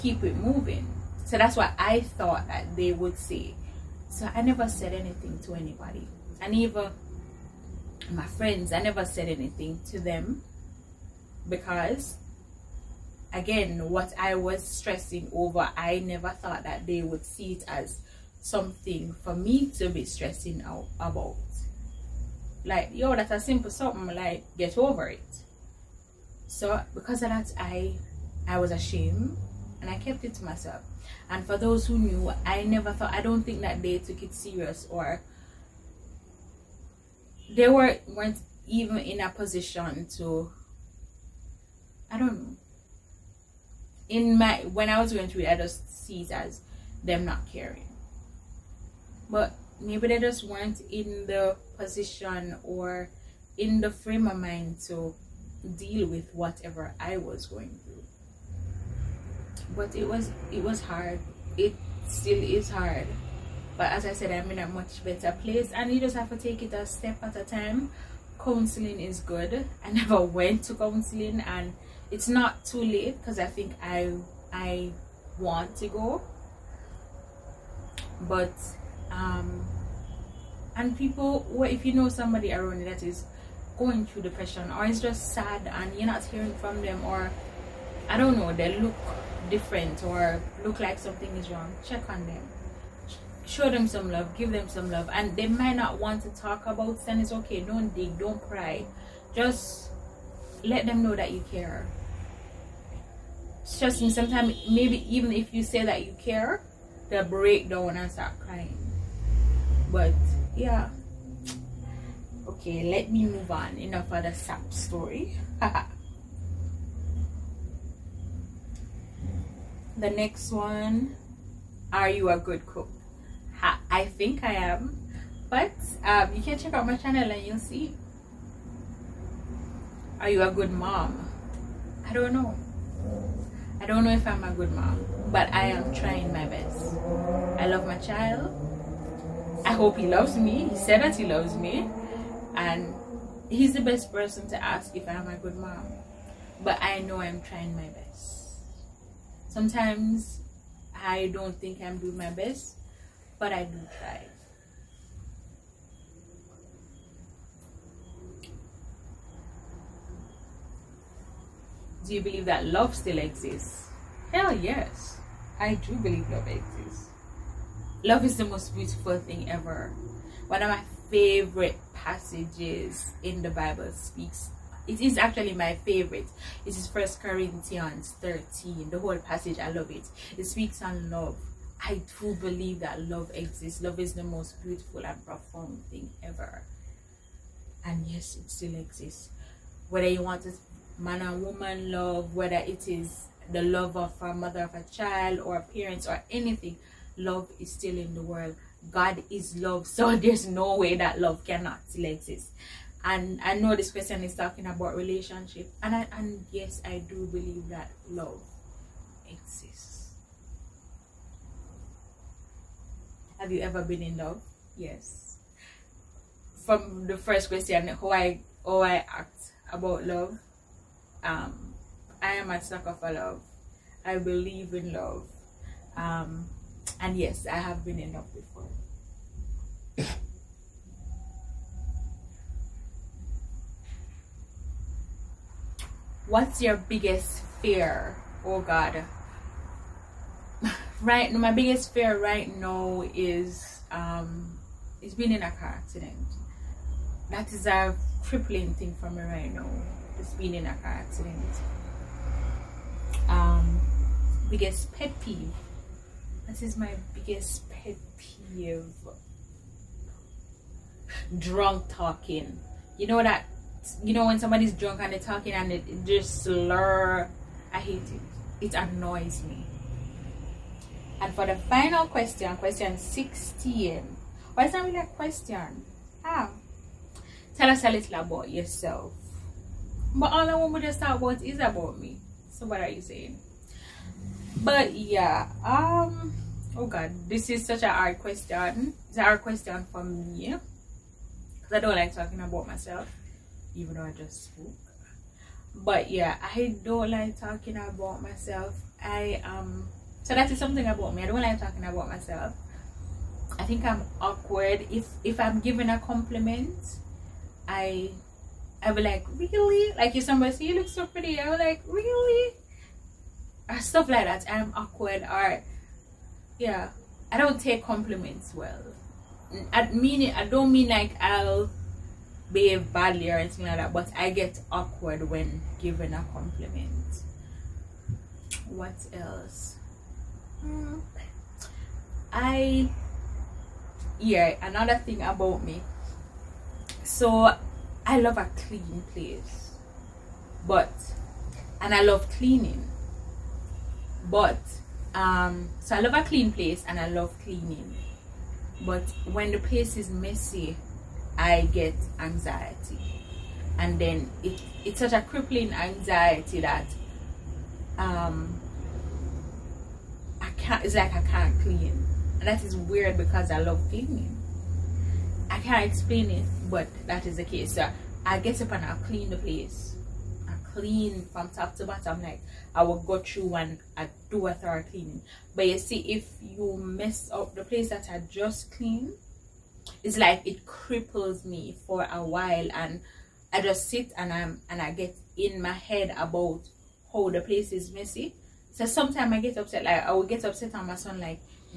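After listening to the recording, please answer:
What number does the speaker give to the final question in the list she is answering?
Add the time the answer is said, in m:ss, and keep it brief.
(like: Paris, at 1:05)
16, at 4:32.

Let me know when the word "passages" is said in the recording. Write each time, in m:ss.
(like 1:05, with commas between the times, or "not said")
2:51, 2:59.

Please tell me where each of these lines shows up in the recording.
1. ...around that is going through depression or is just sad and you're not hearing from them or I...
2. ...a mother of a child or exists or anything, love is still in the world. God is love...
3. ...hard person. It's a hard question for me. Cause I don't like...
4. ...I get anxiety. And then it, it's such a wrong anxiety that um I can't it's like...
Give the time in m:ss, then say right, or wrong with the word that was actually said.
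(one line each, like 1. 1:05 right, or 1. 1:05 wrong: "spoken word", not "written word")
1. 1:22 right
2. 3:14 wrong: "parents", not "exists"
3. 4:47 wrong: "question", not "person"
4. 5:51 wrong: "crippling", not "wrong".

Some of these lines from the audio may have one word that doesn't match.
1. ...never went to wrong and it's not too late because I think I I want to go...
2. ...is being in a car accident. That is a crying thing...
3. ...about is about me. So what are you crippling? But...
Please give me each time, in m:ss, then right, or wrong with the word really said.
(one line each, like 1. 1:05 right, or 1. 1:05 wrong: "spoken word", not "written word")
1. 1:09 wrong: "counseling", not "wrong"
2. 4:05 wrong: "crippling", not "crying"
3. 4:41 wrong: "saying", not "crippling".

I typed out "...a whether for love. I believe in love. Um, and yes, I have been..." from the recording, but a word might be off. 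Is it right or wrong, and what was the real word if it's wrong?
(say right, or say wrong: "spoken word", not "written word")
wrong: "sucker", not "whether".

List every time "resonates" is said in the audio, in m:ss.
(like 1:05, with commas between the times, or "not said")
not said.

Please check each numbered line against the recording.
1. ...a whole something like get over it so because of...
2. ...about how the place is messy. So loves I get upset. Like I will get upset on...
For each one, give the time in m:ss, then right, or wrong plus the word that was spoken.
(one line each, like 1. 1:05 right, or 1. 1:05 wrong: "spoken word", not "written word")
1. 0:23 wrong: "simple", not "whole"
2. 6:26 wrong: "sometimes", not "loves".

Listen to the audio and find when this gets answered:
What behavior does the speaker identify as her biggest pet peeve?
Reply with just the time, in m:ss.
4:21.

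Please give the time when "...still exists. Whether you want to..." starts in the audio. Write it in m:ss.
3:08.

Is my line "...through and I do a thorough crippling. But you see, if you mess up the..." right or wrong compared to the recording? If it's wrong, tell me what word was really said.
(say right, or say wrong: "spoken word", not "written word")
wrong: "cleaning", not "crippling".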